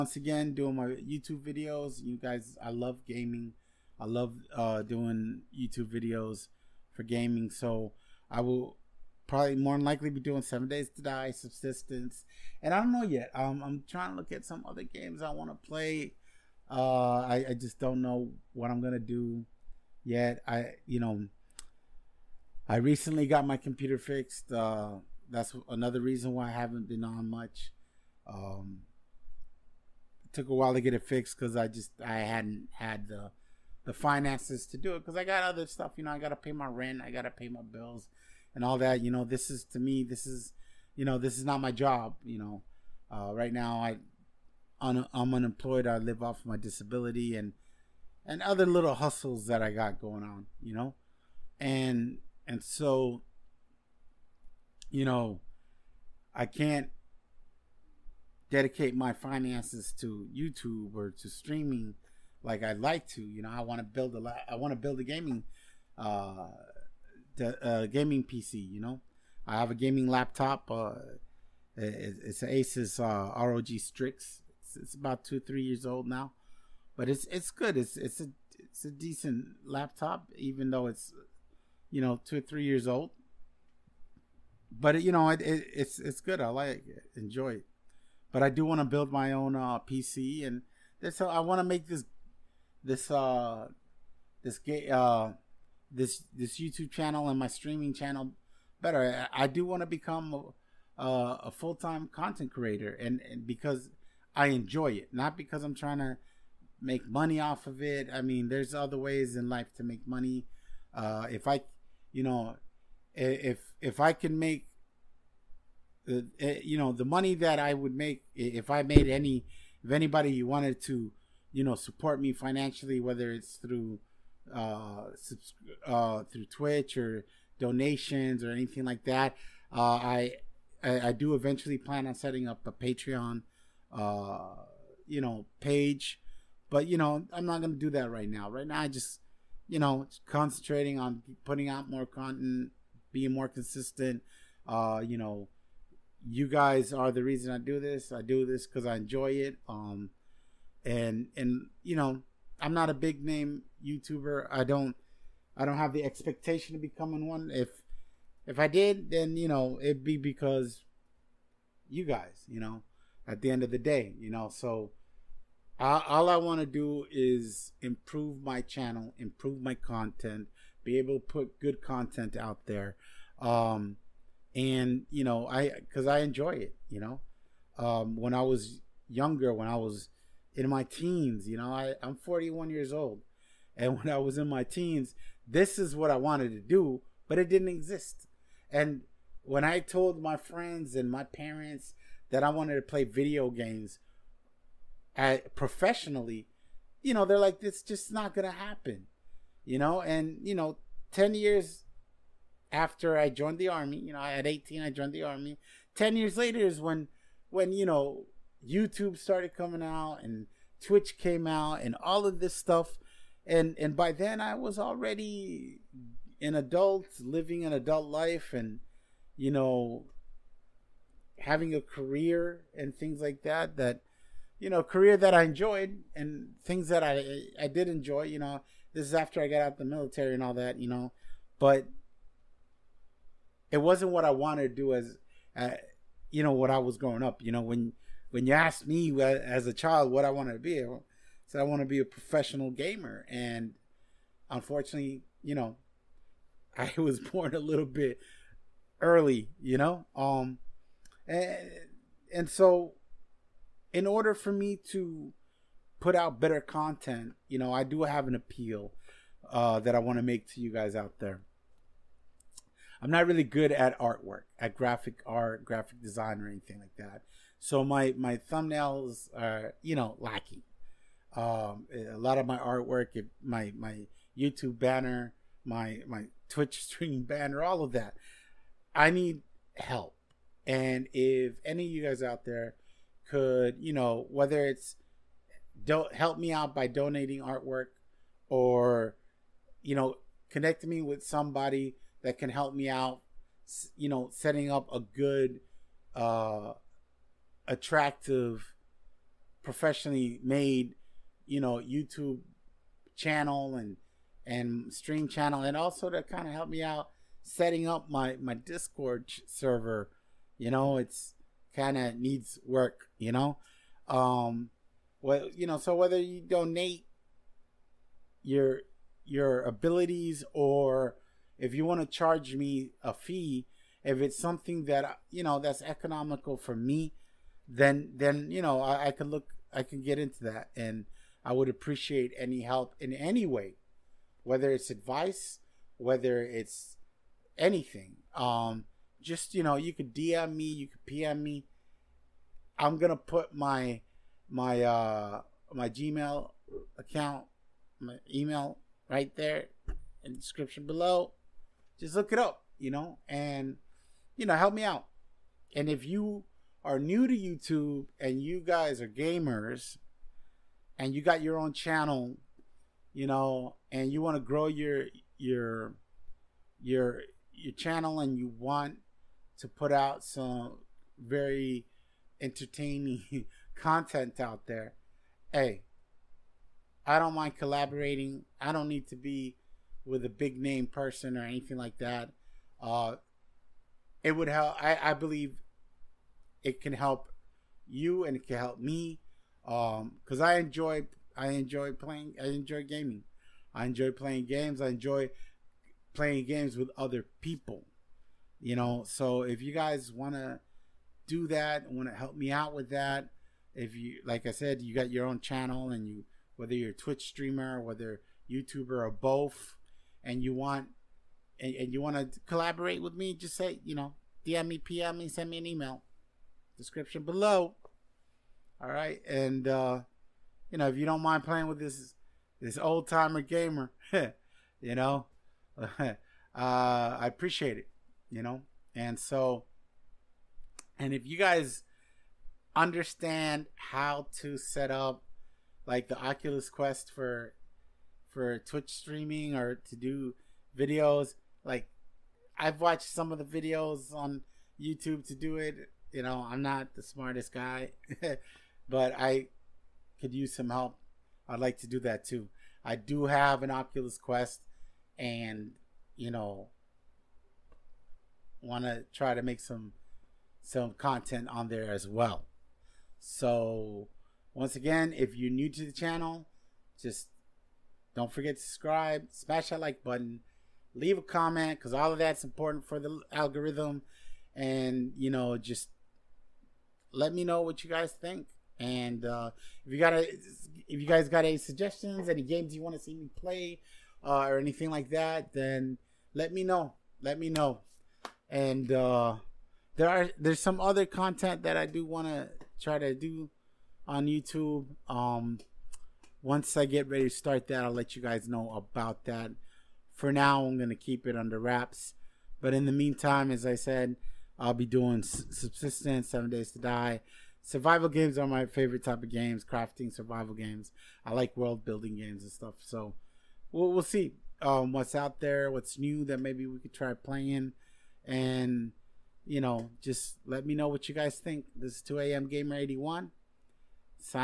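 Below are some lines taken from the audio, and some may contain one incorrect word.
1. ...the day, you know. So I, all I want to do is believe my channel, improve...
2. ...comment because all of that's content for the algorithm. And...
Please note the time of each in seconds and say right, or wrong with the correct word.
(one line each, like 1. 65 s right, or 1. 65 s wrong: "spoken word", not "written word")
1. 163 s wrong: "improve", not "believe"
2. 471 s wrong: "important", not "content".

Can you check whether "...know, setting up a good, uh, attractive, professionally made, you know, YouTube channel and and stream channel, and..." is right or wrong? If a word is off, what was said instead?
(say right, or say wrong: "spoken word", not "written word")
right.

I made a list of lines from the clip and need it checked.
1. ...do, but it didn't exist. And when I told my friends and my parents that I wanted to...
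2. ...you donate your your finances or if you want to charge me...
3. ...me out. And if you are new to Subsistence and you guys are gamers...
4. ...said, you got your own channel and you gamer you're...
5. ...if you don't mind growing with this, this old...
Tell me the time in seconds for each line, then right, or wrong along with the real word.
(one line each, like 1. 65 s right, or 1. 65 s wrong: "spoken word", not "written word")
1. 186 s right
2. 316 s wrong: "abilities", not "finances"
3. 354 s wrong: "YouTube", not "Subsistence"
4. 404 s wrong: "whether", not "gamer"
5. 420 s wrong: "playing", not "growing".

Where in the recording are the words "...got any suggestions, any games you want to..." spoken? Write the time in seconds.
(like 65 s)
481 s.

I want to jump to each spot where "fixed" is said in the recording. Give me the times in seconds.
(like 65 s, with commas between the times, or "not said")
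23 s, 31 s.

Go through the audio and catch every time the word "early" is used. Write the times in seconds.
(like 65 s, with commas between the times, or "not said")
249 s.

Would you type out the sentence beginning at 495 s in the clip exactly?
Um, once I get ready to start that, I'll let you guys know about that.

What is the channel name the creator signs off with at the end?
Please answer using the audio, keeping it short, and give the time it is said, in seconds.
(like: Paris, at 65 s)
2 a.m. Gamer 81, at 522 s.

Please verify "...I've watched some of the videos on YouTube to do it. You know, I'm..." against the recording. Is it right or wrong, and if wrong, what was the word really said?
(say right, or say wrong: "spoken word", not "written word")
right.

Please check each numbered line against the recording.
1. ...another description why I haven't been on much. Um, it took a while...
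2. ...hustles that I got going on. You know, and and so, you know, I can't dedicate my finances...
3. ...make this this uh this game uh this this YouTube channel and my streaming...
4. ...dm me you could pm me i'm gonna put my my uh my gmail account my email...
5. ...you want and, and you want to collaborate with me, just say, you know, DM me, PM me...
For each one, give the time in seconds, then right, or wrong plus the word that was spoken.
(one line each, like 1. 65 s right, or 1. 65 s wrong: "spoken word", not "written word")
1. 25 s wrong: "reason", not "description"
2. 48 s right
3. 91 s right
4. 340 s right
5. 410 s right.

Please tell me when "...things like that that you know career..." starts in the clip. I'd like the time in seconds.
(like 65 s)
222 s.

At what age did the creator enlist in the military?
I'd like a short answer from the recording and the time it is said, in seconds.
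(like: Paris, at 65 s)
18, at 204 s.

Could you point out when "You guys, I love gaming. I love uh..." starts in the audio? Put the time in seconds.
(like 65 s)
2 s.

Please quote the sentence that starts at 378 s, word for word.
I don't need to be with a big name person or anything like that.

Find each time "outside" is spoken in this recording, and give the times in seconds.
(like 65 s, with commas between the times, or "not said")
not said.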